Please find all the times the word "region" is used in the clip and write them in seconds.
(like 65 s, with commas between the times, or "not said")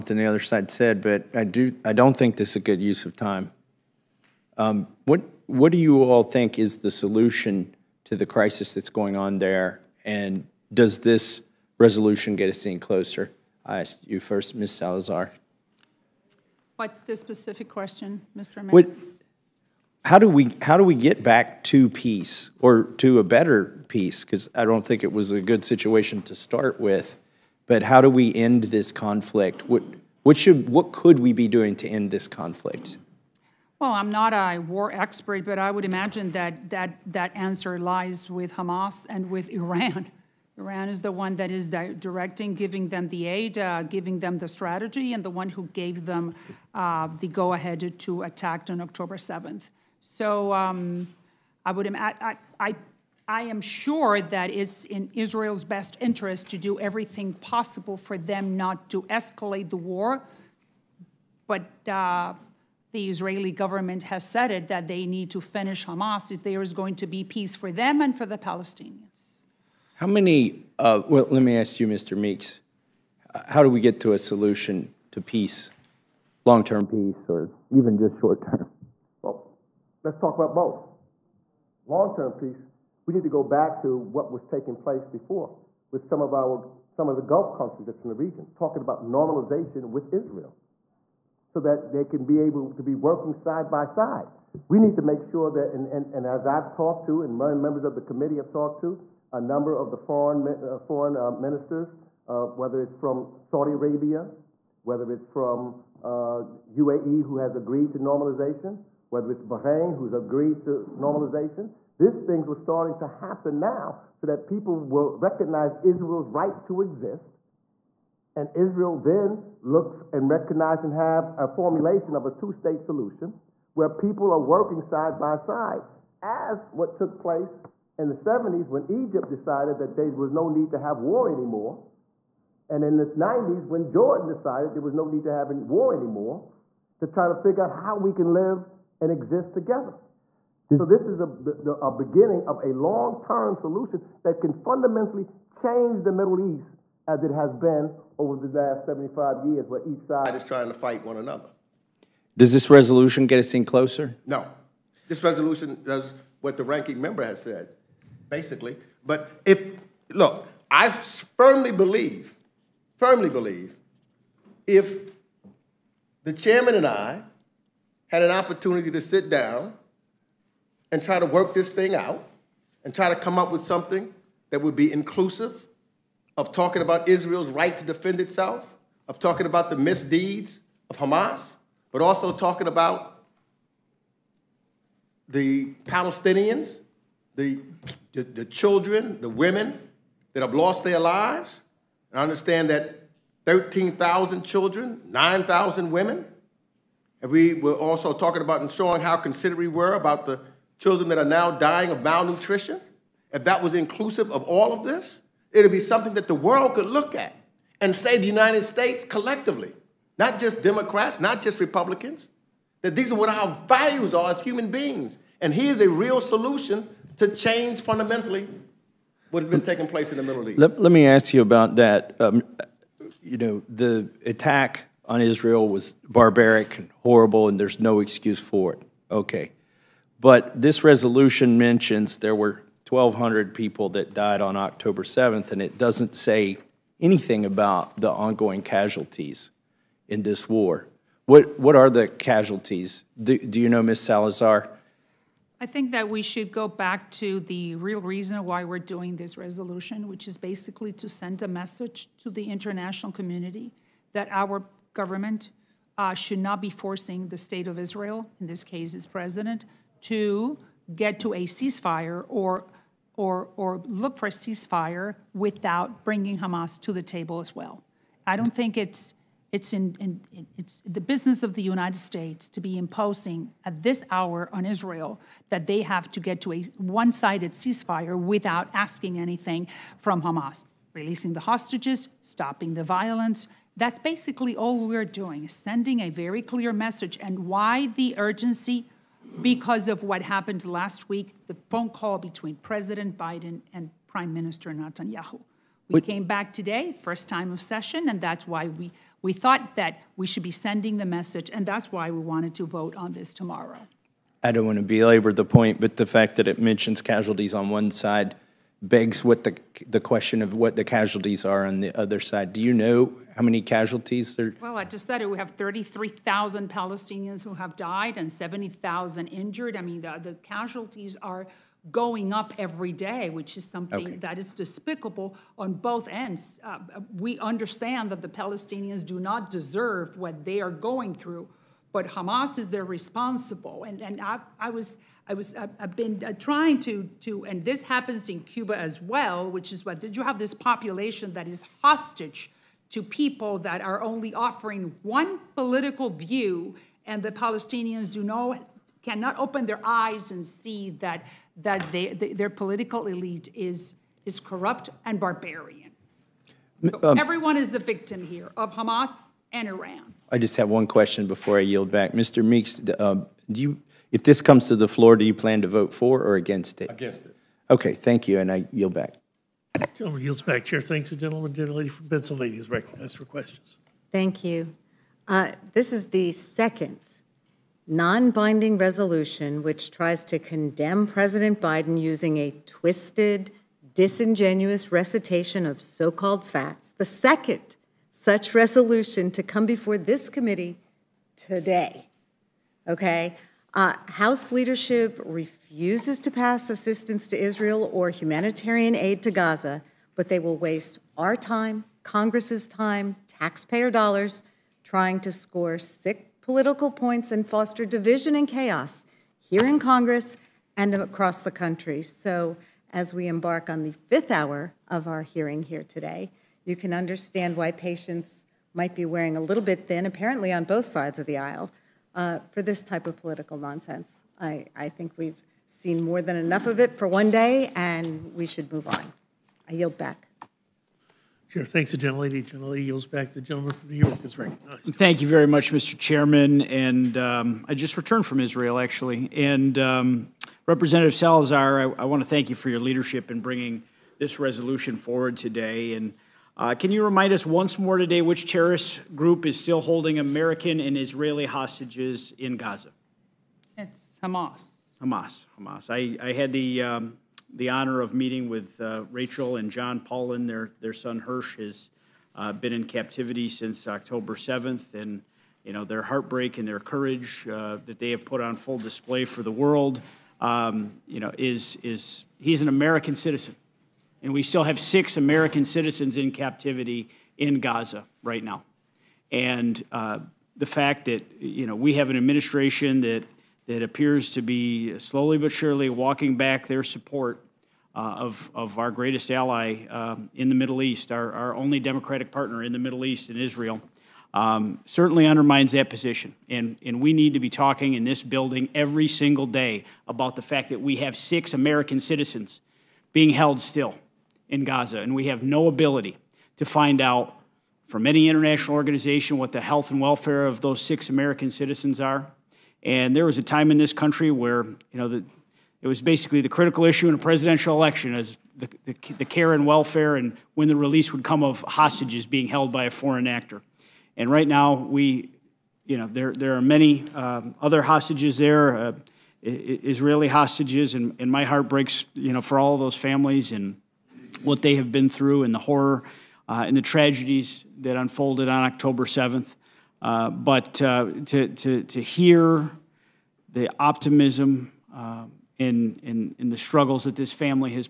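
88 s.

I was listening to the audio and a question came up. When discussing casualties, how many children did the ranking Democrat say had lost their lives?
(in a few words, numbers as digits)
13,000.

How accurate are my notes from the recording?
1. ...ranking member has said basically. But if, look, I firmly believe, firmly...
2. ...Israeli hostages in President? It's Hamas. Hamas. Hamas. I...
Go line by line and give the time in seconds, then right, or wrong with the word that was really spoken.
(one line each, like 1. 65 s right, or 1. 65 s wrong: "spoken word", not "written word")
1. 156 s right
2. 450 s wrong: "Gaza", not "President".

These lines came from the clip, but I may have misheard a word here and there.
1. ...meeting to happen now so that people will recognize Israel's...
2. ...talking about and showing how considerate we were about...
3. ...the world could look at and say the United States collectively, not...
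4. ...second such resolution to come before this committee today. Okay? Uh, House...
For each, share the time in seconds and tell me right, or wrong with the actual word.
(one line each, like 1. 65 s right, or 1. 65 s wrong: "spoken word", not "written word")
1. 112 s wrong: "starting", not "meeting"
2. 198 s right
3. 206 s right
4. 387 s right.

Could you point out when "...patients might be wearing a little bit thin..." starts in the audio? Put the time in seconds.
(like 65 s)
417 s.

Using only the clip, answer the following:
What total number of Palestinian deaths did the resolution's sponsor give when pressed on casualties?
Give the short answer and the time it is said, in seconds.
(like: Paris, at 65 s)
33,000, at 315 s.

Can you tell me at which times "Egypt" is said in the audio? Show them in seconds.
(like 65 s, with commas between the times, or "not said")
128 s.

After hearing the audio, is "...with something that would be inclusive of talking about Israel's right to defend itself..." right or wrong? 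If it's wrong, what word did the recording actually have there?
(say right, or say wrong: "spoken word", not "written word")
right.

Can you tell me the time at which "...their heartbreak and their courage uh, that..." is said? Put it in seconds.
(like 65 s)
465 s.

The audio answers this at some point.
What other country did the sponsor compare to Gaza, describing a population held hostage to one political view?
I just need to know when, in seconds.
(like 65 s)
338 s.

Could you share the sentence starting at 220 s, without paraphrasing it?
Let, let me ask you about that.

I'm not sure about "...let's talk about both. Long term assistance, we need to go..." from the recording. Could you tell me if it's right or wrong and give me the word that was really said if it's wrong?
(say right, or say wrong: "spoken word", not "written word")
wrong: "peace", not "assistance".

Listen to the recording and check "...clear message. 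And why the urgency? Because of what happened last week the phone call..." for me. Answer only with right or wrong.
right.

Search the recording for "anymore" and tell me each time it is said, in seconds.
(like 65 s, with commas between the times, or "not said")
131 s, 135 s.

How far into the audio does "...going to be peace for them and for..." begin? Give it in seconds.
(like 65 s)
66 s.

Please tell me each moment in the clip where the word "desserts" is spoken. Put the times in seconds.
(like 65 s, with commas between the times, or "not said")
not said.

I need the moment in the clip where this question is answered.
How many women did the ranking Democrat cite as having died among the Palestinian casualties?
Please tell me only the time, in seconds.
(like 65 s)
195 s.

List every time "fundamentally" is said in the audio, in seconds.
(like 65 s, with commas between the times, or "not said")
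144 s, 217 s.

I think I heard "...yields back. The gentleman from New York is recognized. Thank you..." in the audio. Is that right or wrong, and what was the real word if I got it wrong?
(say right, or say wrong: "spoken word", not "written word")
right.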